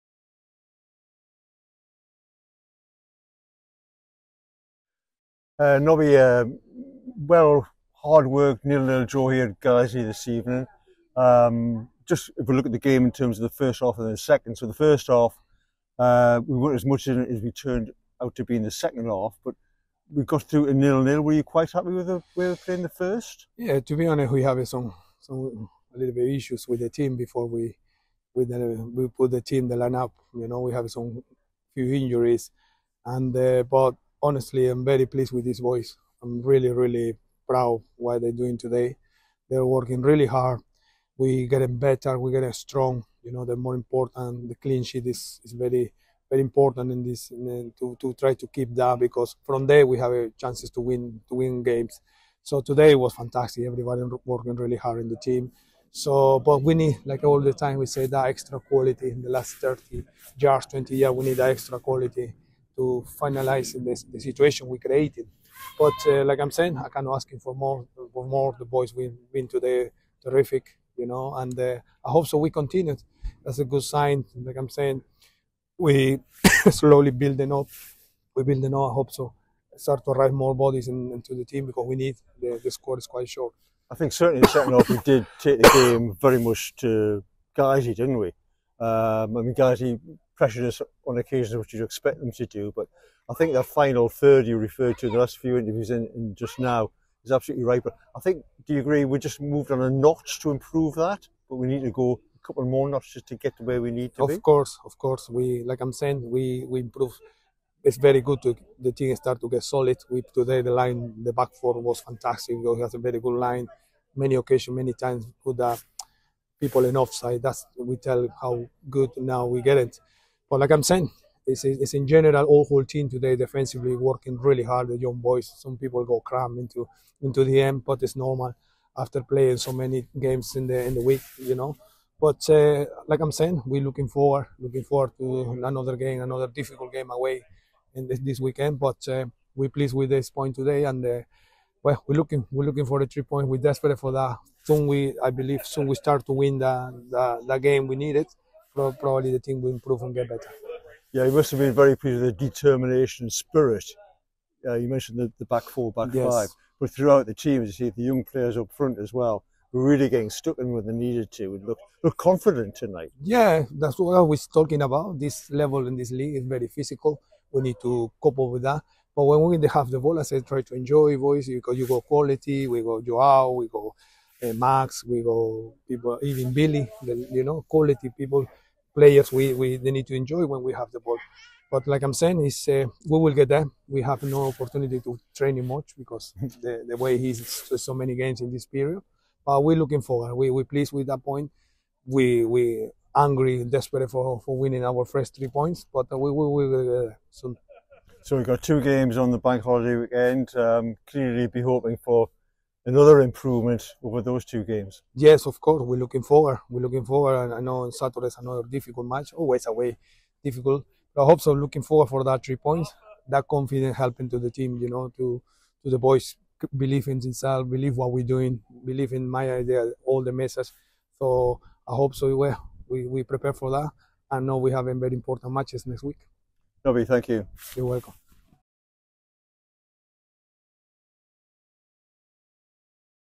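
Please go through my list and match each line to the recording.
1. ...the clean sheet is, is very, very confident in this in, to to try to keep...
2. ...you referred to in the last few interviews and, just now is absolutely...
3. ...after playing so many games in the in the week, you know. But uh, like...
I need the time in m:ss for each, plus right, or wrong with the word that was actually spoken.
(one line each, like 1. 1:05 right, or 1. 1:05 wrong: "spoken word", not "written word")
1. 0:44 wrong: "important", not "confident"
2. 1:34 right
3. 2:08 right.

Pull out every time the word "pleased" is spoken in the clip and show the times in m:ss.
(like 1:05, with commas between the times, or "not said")
0:35, 2:19, 2:31, 3:10.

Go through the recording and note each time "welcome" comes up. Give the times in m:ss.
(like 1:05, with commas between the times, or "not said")
3:47.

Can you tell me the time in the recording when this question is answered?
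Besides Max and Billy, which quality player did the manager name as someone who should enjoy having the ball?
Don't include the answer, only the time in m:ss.
2:53.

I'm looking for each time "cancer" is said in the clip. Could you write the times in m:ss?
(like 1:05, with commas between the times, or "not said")
not said.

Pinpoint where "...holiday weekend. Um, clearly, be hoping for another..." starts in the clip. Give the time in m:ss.
3:19.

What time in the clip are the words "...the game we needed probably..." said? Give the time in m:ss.
2:27.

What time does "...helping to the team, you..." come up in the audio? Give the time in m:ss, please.
3:33.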